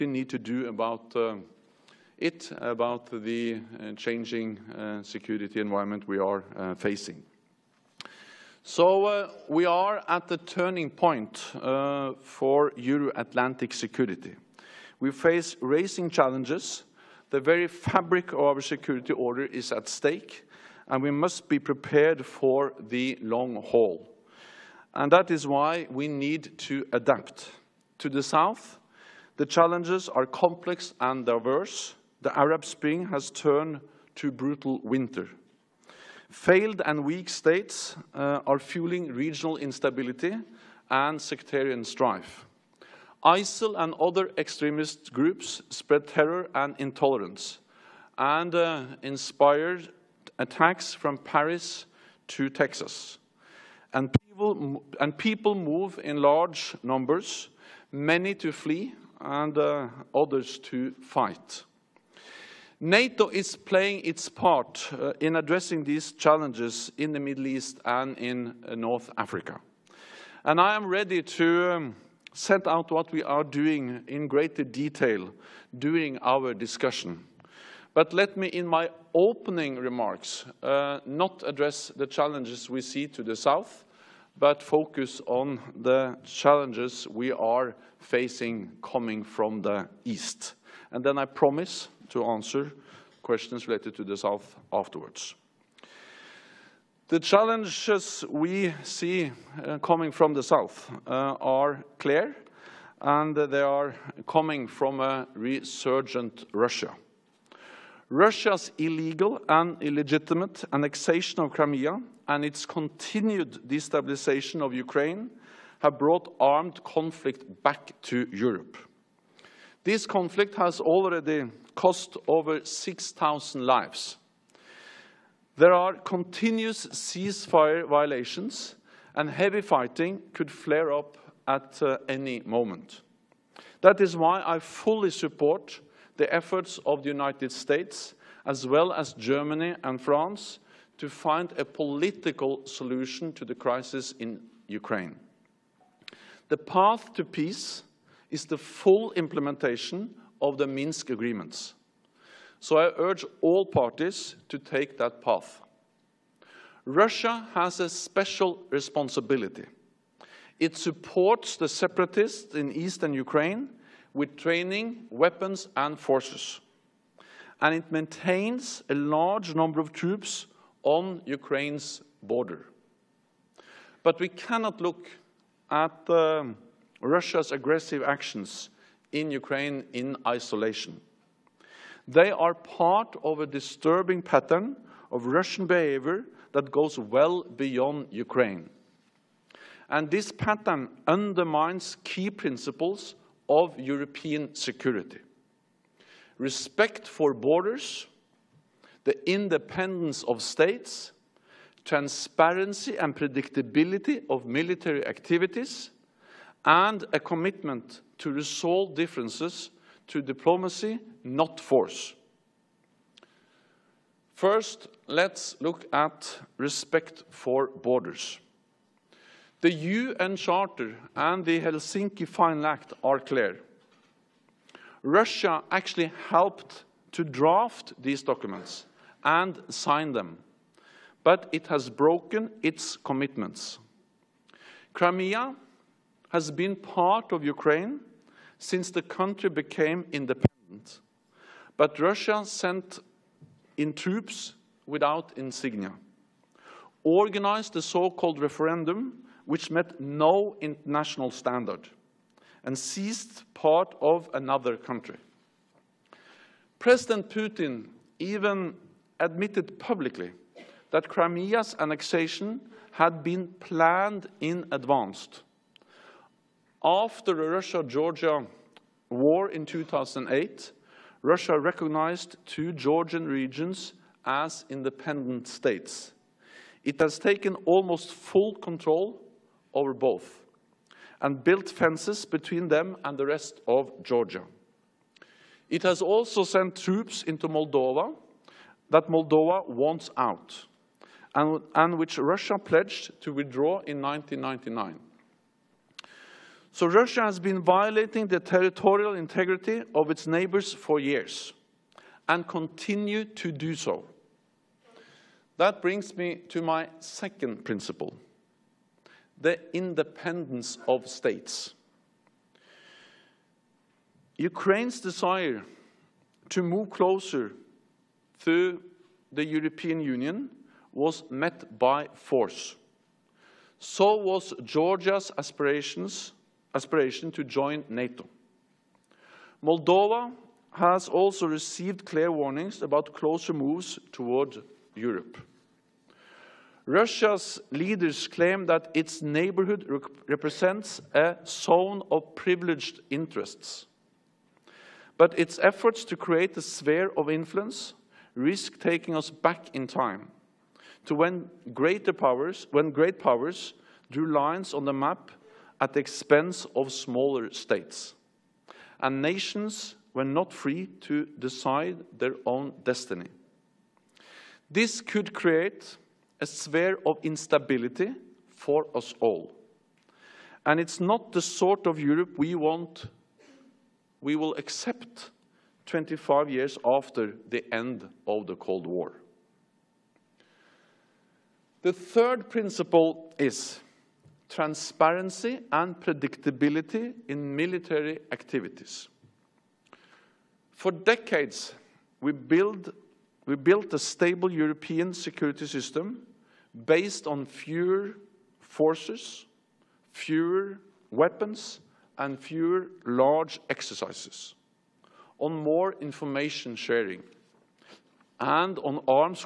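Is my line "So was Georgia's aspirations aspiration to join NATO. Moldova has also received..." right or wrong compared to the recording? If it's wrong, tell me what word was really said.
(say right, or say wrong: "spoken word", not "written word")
right.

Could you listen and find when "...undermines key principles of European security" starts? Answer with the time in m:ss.
3:11.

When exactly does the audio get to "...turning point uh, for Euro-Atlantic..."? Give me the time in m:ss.
0:10.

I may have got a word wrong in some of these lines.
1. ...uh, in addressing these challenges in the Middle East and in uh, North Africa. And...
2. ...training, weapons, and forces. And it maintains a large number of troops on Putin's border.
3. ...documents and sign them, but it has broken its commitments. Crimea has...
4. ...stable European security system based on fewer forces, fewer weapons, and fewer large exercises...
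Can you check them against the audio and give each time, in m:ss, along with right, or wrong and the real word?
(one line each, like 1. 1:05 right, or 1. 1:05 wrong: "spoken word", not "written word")
1. 1:04 right
2. 2:44 wrong: "Ukraine", not "Putin"
3. 3:48 right
4. 6:33 right.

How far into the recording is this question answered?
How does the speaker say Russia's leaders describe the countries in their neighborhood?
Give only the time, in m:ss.
5:41.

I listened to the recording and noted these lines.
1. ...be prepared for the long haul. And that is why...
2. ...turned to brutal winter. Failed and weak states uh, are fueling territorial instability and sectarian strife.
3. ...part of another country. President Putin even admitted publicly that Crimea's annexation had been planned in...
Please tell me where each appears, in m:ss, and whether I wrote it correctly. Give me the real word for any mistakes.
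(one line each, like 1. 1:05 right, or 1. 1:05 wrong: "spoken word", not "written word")
1. 0:21 right
2. 0:33 wrong: "regional", not "territorial"
3. 4:13 right.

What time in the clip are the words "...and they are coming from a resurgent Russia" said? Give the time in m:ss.
1:43.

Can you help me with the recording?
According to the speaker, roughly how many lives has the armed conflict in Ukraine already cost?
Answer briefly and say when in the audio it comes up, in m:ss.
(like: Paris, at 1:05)
over 6,000, at 2:02.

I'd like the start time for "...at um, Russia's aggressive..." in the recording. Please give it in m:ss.
2:55.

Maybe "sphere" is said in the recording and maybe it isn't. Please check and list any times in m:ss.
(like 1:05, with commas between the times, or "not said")
5:46, 6:06.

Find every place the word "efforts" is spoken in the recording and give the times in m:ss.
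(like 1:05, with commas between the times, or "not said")
2:16, 5:45.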